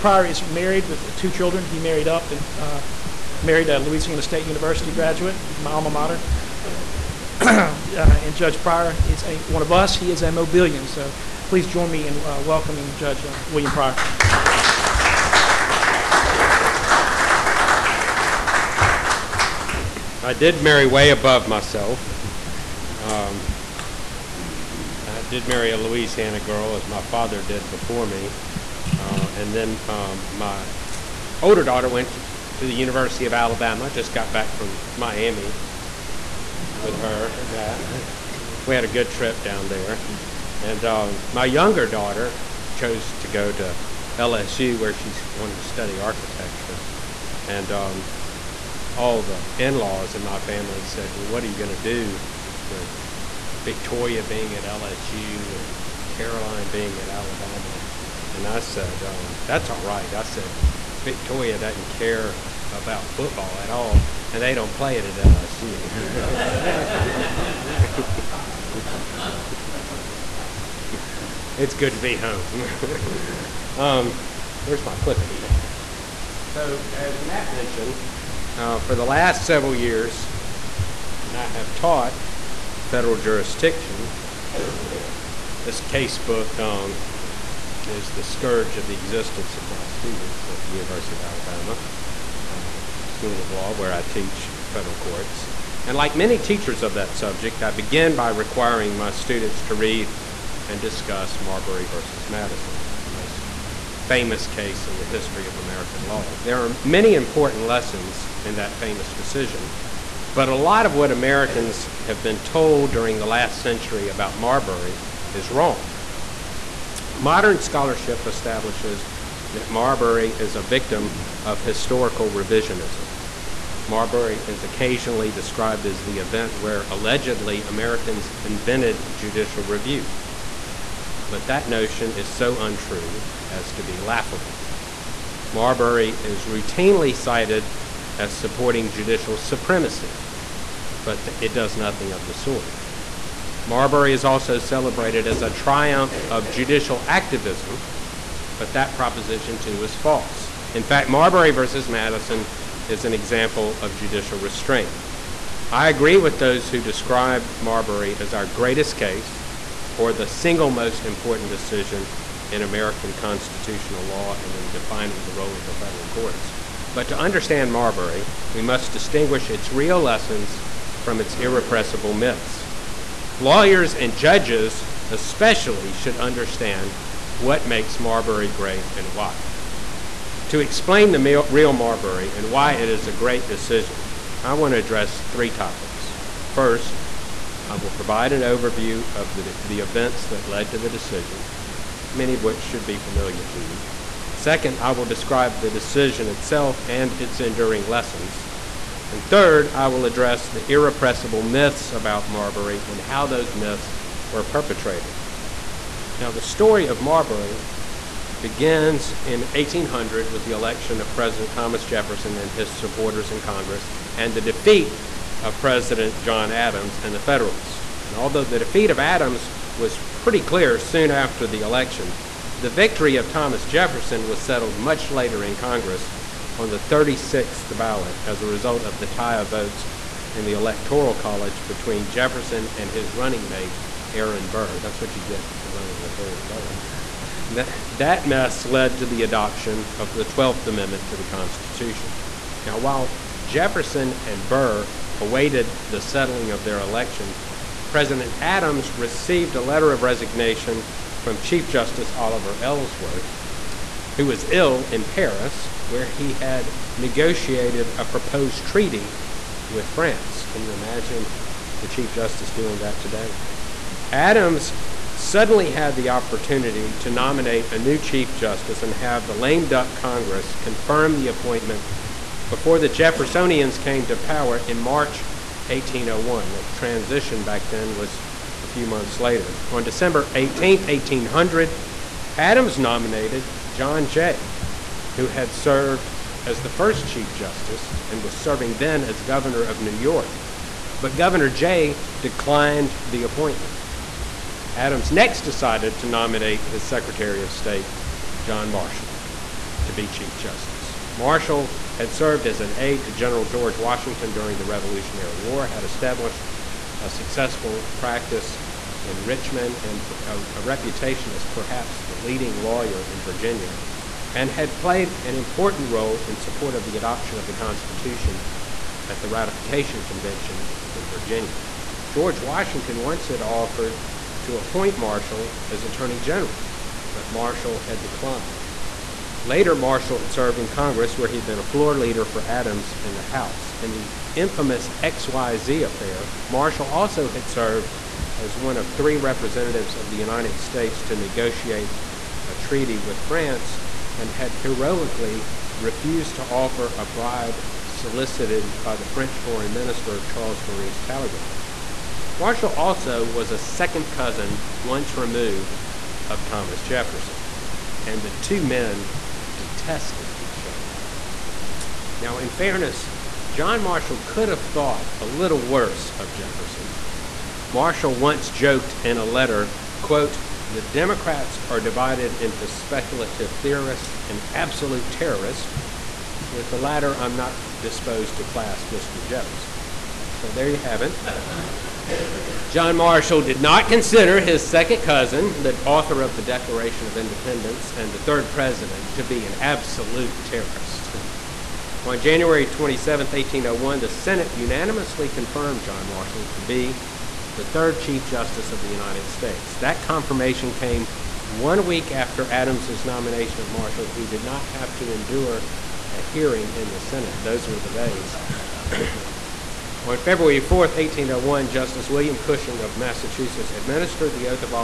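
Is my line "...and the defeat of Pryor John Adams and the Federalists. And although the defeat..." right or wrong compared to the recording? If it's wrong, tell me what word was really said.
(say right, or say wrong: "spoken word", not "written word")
wrong: "President", not "Pryor".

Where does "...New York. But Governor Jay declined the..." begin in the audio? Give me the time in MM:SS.
04:49.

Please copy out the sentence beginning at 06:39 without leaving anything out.
That confirmation came one week after Adams's nomination of Marshall, who did not have to endure a hearing in the Senate.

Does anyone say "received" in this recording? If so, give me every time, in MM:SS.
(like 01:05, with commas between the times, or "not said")
04:08.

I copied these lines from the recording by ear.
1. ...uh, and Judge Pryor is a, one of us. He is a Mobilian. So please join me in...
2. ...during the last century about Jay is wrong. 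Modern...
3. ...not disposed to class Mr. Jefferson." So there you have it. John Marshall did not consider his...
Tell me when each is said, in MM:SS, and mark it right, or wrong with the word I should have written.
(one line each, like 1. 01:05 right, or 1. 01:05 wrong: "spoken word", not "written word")
1. 00:07 right
2. 01:52 wrong: "Marbury", not "Jay"
3. 06:17 right.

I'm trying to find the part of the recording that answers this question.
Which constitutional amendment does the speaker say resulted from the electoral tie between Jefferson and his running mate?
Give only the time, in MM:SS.
04:00.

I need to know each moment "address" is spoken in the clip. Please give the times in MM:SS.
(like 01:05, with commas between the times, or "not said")
03:04, 03:20.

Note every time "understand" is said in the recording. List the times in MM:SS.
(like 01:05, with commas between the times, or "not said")
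02:47, 02:56.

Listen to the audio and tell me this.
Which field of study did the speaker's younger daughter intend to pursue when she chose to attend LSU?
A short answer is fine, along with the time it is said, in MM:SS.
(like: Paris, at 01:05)
architecture, at 00:45.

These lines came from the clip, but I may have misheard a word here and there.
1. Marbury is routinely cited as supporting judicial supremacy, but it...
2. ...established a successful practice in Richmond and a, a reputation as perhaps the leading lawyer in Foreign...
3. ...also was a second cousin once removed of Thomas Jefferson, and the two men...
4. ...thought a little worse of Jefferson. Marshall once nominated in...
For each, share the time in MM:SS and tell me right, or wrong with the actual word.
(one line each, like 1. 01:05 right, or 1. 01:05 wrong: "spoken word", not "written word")
1. 02:15 right
2. 05:05 wrong: "Virginia", not "Foreign"
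3. 05:52 right
4. 06:04 wrong: "joked", not "nominated".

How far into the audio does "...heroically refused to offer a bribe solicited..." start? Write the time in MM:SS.
05:44.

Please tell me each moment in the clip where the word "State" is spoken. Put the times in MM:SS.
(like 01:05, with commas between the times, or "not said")
00:04, 04:57, 05:40, 06:39.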